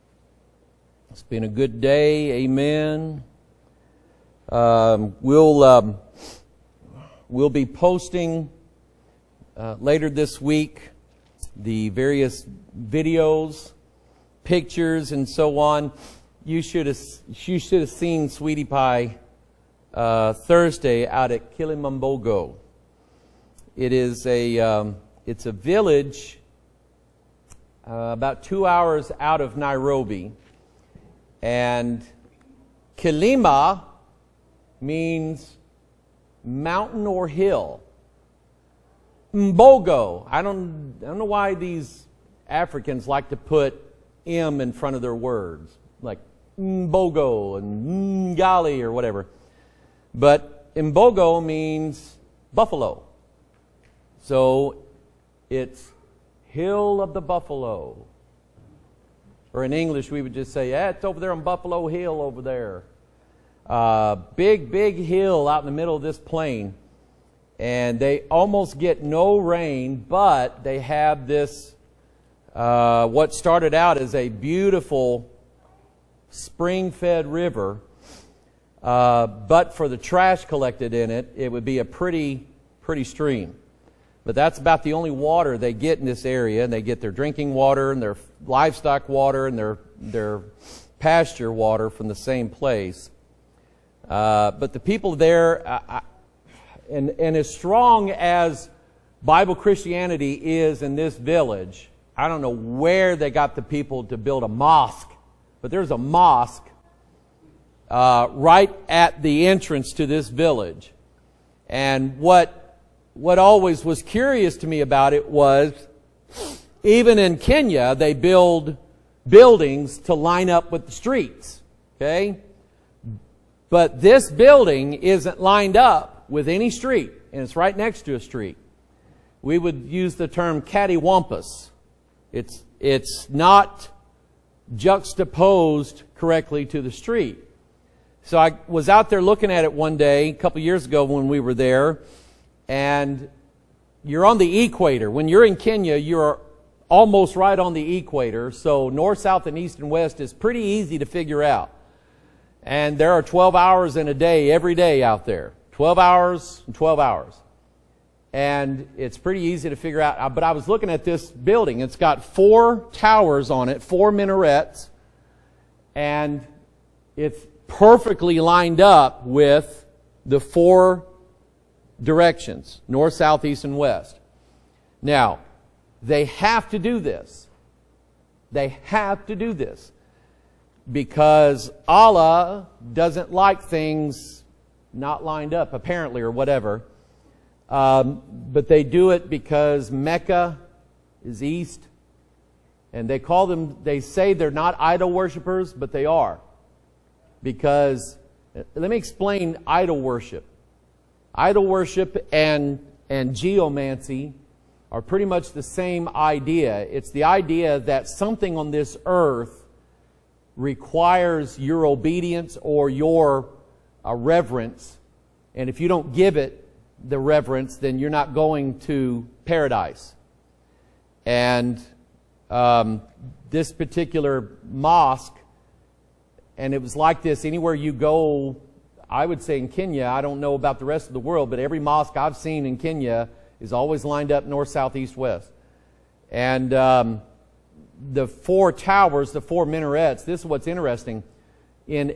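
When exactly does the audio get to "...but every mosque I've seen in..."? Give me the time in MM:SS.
03:51.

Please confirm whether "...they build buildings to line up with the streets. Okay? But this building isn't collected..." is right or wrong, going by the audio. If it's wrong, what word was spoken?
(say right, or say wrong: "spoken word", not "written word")
wrong: "lined", not "collected".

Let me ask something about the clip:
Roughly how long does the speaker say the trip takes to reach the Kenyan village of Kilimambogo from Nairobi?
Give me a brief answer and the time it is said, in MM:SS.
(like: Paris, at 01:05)
2 hours, at 00:28.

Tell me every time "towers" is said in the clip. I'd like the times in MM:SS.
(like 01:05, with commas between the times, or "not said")
02:42, 03:58.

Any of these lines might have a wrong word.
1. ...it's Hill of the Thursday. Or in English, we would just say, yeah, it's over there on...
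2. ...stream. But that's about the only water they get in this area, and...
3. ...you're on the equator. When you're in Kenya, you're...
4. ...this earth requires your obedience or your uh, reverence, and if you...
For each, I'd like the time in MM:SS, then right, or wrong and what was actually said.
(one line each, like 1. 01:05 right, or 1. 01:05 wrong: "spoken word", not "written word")
1. 00:55 wrong: "Buffalo", not "Thursday"
2. 01:23 right
3. 02:24 right
4. 03:28 right.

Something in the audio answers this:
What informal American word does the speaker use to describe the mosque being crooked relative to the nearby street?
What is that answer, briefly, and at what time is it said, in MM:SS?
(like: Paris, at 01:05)
cattywampus, at 02:10.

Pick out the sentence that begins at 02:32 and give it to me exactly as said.
And there are 12 hours in a day every day out there.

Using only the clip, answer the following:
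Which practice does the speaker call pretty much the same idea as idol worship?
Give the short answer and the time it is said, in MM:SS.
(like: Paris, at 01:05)
geomancy, at 03:23.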